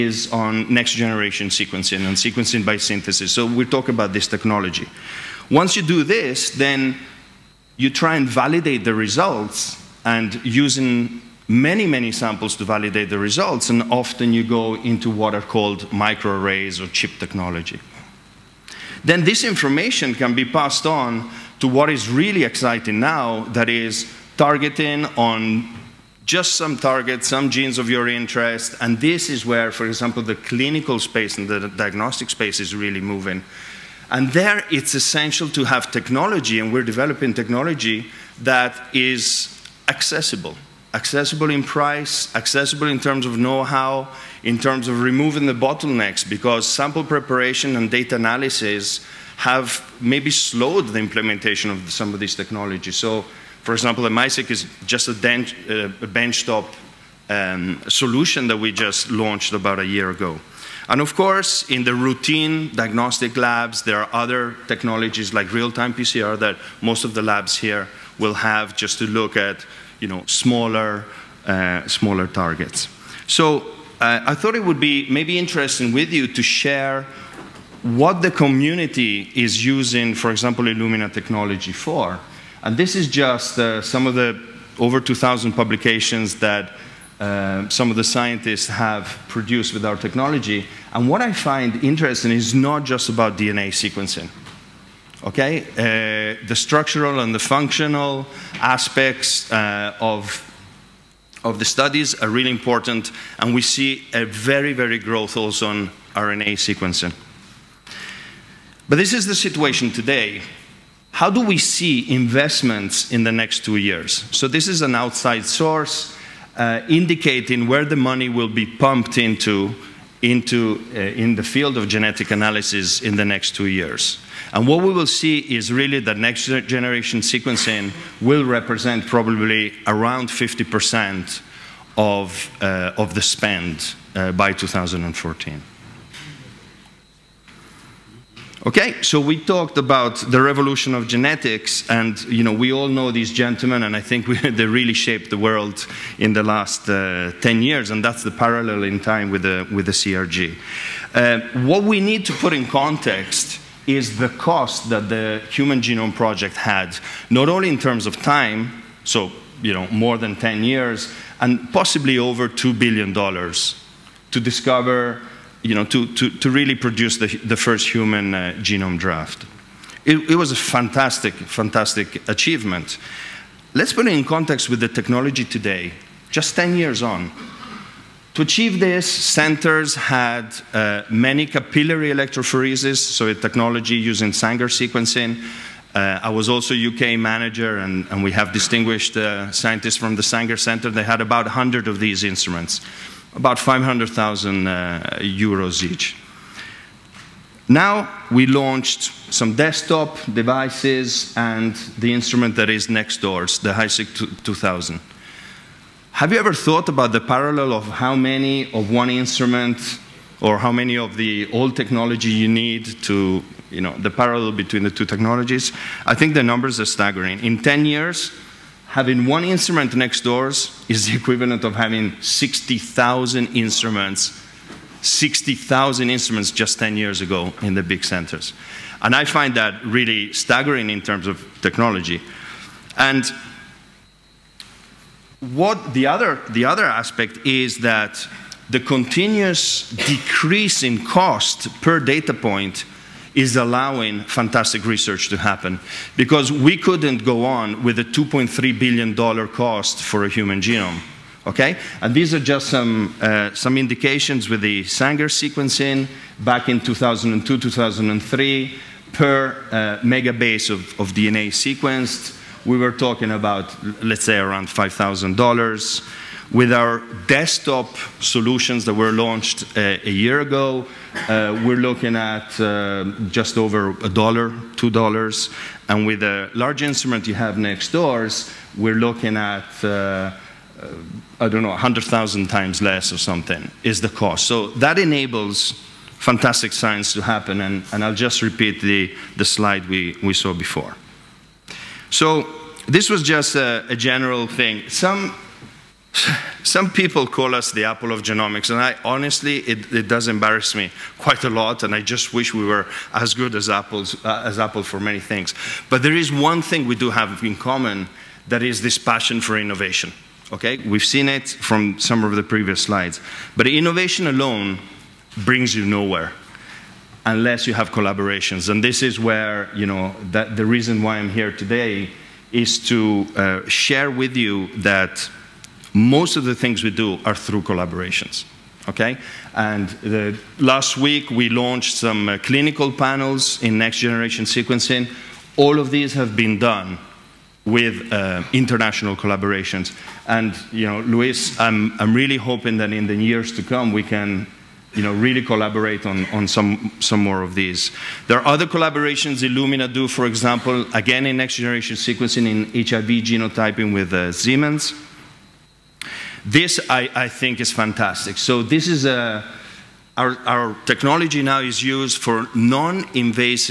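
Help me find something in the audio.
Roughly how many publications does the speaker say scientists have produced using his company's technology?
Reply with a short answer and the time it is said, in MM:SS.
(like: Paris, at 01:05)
over 2,000, at 01:24.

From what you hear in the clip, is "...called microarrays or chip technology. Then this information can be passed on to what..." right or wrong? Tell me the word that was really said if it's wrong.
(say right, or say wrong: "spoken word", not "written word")
right.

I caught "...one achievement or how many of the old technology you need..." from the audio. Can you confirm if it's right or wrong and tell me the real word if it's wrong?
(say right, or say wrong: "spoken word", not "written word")
wrong: "instrument", not "achievement".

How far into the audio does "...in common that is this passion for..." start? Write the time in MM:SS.
05:07.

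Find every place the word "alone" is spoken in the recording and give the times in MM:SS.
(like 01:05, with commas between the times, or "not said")
05:14.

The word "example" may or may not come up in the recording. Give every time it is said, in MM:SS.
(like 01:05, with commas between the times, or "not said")
00:29, 00:53, 01:20, 05:50.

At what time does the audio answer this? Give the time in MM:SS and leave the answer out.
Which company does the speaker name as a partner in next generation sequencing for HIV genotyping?
05:54.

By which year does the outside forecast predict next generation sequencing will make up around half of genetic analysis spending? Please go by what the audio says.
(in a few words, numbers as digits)
2014.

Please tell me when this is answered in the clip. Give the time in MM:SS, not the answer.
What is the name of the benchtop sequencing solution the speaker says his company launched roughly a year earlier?
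00:54.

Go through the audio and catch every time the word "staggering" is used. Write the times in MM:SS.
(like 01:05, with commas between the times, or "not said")
03:36, 03:50.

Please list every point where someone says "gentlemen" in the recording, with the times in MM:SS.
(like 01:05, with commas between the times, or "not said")
02:23.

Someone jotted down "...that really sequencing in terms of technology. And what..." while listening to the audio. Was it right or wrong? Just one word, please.
wrong.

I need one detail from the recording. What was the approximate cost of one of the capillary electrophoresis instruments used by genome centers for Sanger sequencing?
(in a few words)
500,000 euros.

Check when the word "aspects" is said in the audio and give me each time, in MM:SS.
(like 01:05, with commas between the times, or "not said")
01:38, 03:56.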